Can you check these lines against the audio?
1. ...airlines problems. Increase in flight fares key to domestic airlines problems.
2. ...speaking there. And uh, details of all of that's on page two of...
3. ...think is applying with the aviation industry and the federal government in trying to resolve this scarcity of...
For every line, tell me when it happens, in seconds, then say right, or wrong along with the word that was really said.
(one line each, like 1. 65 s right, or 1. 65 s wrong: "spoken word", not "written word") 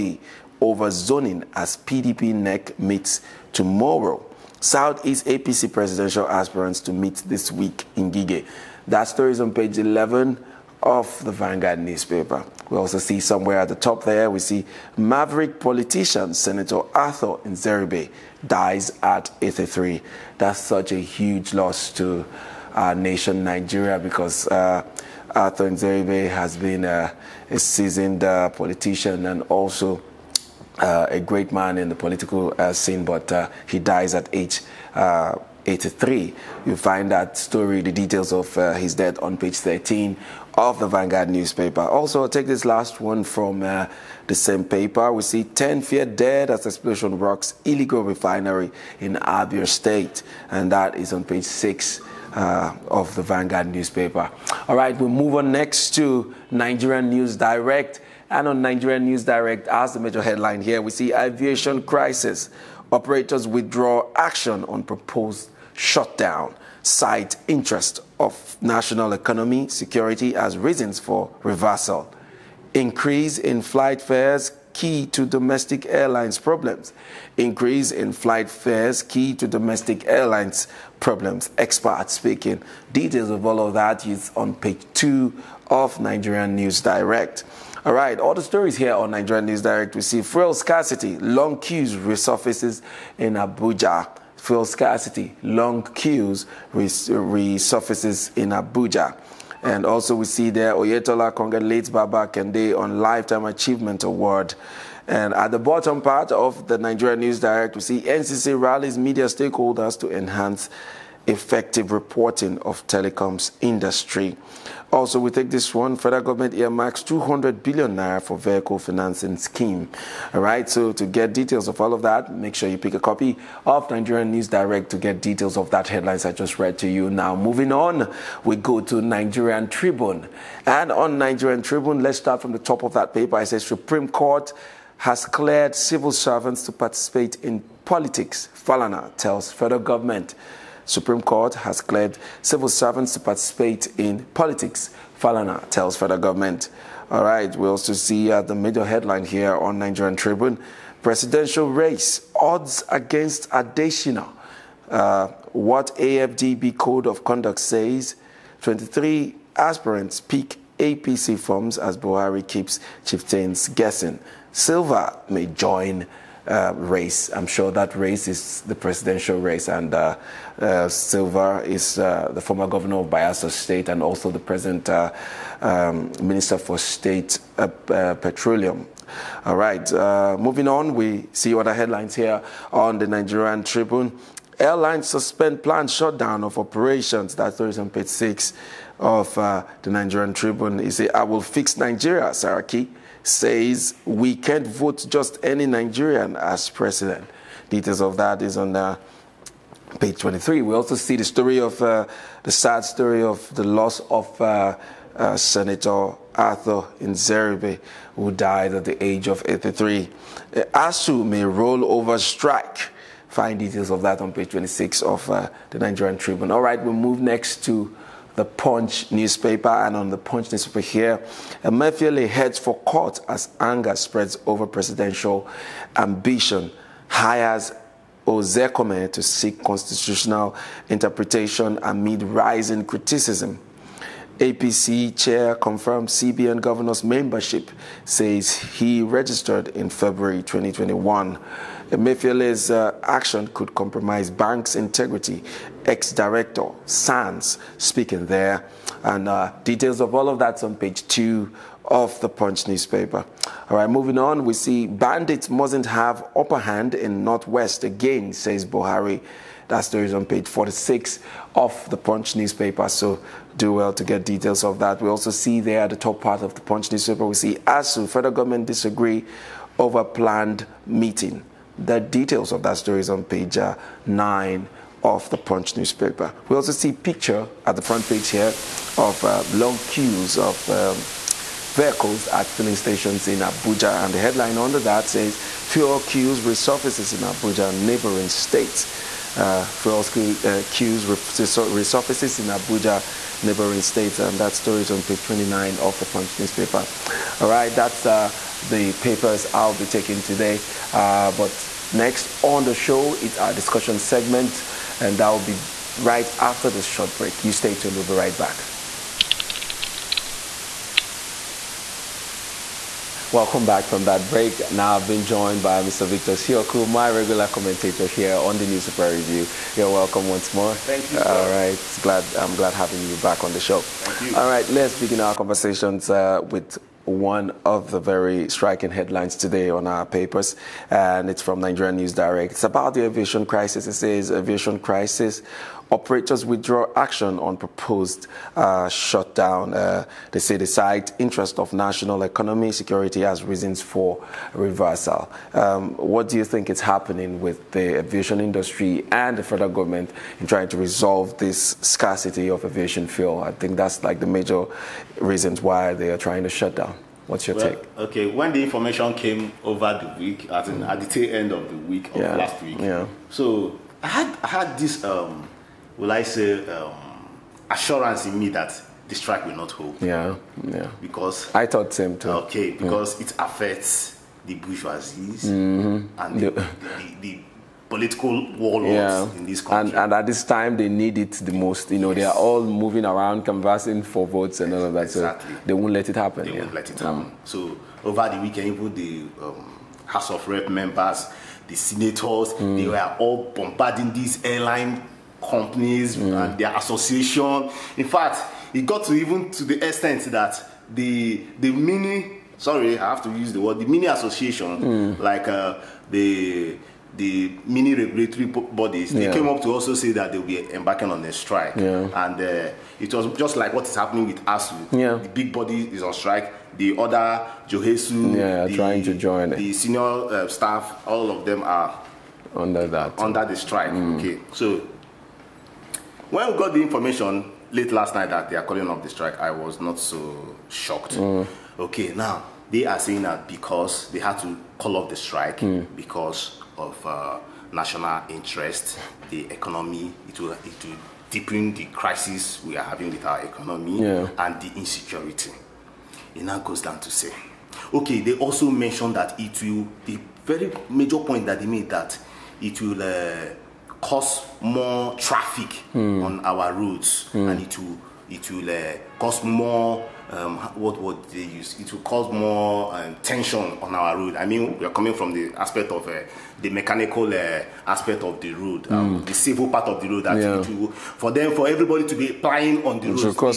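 1. 75 s right
2. 247 s right
3. 346 s wrong: "happening", not "applying".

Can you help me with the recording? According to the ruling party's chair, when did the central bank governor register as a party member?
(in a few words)
February 2021.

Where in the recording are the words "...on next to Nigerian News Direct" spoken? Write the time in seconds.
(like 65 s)
55 s.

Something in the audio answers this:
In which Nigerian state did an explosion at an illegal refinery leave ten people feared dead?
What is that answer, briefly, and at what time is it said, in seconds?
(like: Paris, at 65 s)
Abia State, at 49 s.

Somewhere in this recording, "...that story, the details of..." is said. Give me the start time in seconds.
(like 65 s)
37 s.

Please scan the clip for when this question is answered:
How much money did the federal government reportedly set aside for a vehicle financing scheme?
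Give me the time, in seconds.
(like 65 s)
117 s.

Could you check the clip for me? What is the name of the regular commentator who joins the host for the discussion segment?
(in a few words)
Victor Sioku.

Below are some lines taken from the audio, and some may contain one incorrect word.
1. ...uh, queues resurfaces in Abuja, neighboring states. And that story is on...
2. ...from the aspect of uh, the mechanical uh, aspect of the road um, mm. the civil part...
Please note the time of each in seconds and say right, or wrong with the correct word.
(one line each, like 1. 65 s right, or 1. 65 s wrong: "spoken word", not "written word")
1. 289 s right
2. 465 s right.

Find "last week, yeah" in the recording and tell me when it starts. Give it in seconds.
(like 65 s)
362 s.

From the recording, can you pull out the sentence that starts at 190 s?
He said, I will fix Nigeria, Saraki says we can't vote just any Nigerian as president.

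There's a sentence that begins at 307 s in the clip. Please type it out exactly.
You stay tuned, we'll be right back.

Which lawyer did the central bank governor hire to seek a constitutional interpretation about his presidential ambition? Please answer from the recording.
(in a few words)
Ozekome.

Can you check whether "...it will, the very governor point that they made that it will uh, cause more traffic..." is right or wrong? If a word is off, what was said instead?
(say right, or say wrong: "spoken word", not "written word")
wrong: "major", not "governor".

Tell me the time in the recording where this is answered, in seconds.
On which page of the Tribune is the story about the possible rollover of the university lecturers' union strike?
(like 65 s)
214 s.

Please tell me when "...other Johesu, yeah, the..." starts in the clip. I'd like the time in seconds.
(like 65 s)
416 s.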